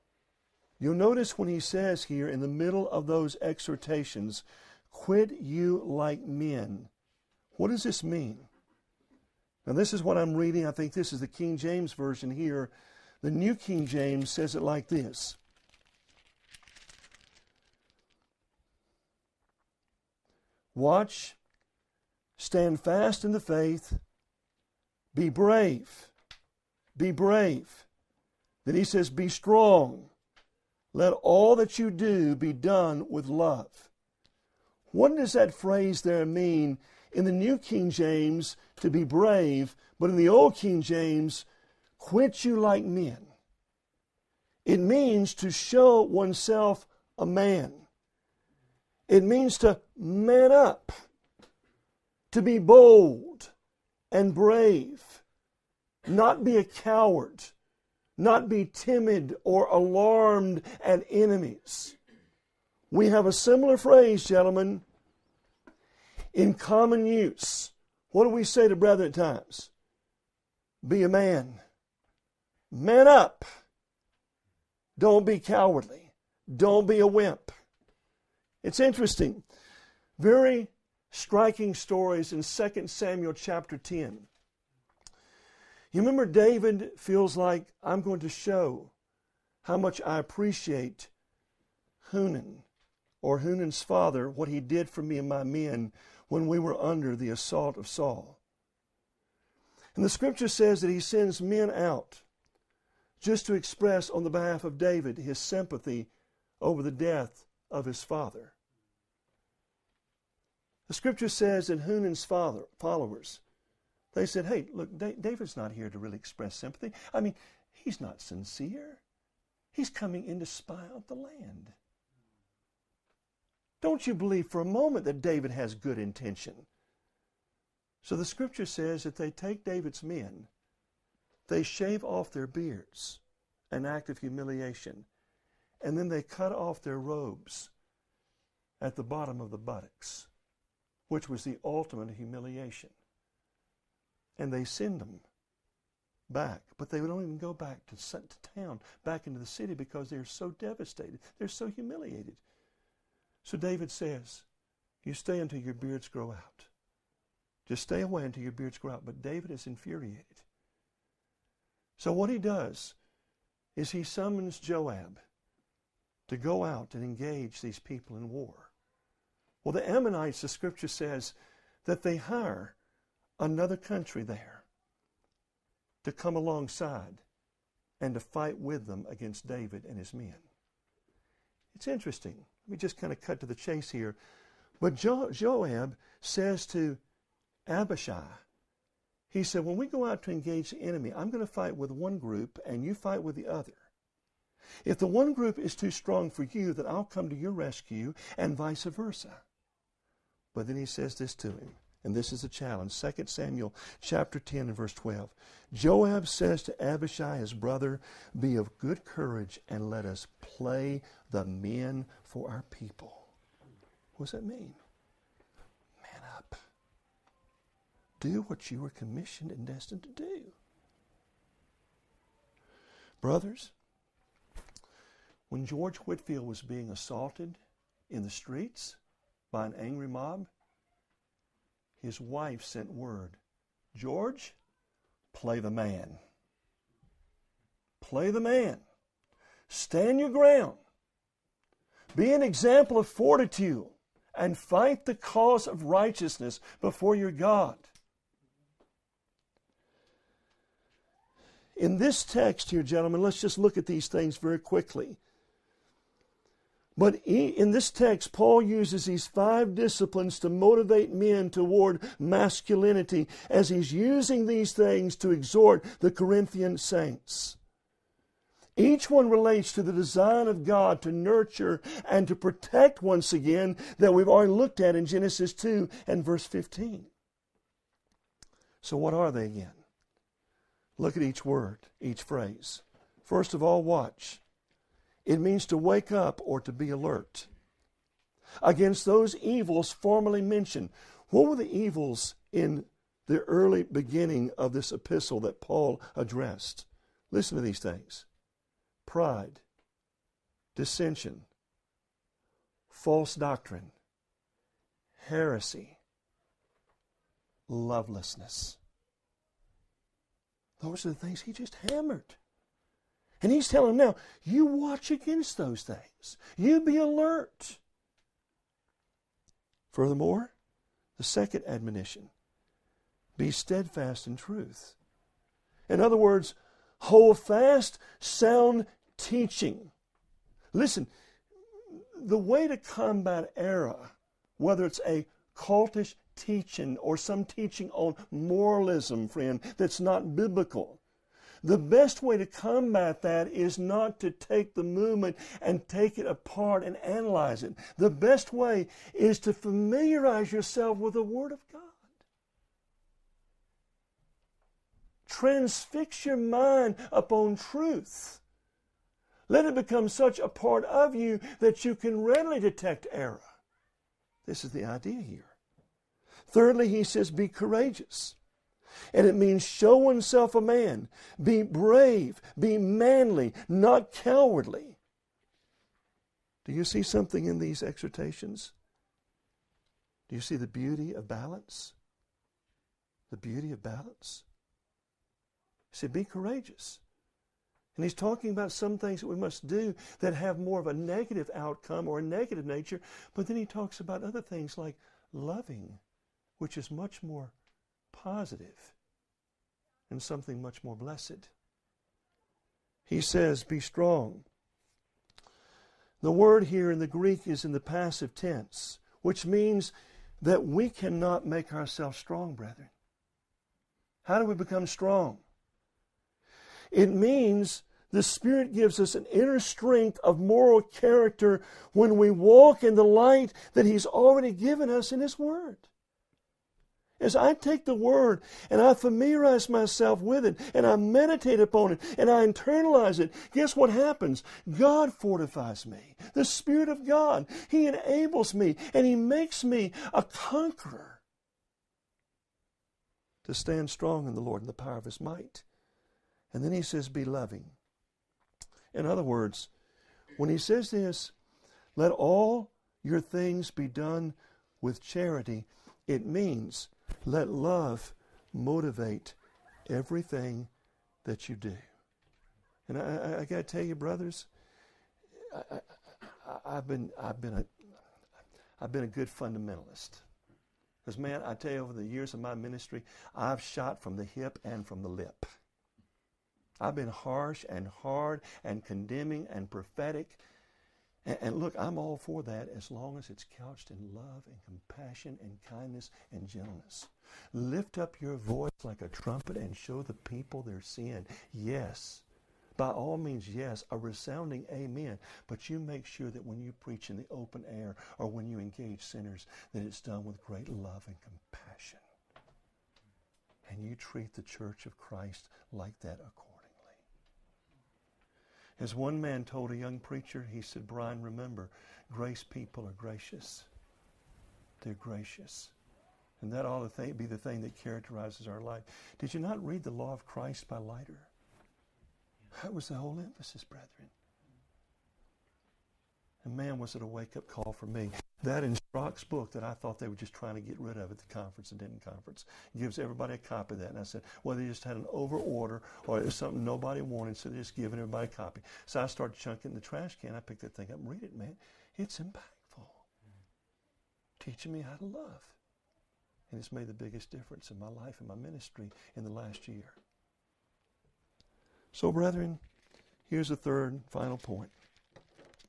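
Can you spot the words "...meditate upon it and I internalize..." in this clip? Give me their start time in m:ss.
7:10.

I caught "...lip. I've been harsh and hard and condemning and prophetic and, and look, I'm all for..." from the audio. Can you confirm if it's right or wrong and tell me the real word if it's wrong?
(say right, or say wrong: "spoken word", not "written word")
right.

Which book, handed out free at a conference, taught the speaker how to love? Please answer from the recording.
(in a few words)
The Law of Christ.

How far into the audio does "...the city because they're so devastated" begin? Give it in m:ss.
2:29.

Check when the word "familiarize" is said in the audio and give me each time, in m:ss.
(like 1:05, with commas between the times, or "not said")
5:49, 7:08.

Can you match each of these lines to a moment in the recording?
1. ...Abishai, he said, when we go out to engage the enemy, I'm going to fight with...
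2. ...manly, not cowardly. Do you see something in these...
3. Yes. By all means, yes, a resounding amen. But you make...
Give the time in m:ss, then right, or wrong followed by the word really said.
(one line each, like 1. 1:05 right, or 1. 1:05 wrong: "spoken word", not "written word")
1. 3:07 right
2. 6:12 right
3. 8:11 right.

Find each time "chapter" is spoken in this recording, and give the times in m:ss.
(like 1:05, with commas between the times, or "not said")
1:23, 3:23.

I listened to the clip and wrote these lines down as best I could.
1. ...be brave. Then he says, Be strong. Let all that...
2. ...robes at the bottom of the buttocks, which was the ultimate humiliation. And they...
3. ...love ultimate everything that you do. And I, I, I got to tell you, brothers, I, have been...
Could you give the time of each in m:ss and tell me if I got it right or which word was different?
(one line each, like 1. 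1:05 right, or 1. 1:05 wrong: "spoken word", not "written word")
1. 0:26 right
2. 2:16 right
3. 7:37 wrong: "motivate", not "ultimate".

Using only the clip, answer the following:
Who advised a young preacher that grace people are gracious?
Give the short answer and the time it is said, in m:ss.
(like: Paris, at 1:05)
Brian, at 8:30.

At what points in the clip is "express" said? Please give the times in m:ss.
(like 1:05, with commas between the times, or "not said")
1:43, 1:56.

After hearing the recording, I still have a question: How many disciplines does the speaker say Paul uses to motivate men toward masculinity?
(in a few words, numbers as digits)
5.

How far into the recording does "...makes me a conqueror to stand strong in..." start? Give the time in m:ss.
7:19.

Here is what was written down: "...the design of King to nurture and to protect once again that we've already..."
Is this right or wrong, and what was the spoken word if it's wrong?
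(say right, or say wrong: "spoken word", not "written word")
wrong: "God", not "King".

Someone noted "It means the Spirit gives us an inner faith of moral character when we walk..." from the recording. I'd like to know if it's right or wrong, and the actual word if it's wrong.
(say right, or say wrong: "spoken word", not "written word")
wrong: "strength", not "faith".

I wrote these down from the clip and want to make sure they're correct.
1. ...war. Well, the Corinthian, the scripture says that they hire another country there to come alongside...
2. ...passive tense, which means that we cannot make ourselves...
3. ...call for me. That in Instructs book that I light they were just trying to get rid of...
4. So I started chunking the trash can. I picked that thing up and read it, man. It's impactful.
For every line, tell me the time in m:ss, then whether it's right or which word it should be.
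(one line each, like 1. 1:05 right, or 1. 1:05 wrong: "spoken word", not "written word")
1. 2:48 wrong: "Ammonites", not "Corinthian"
2. 6:47 right
3. 8:47 wrong: "thought", not "light"
4. 8:58 right.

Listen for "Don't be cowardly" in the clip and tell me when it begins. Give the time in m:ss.
1:14.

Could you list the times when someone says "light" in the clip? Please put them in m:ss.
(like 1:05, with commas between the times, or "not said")
7:03.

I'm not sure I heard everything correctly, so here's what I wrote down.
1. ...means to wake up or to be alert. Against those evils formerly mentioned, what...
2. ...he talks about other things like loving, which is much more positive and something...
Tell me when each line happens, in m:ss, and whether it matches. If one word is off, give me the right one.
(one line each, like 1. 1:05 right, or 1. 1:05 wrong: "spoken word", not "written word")
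1. 4:45 right
2. 6:33 right.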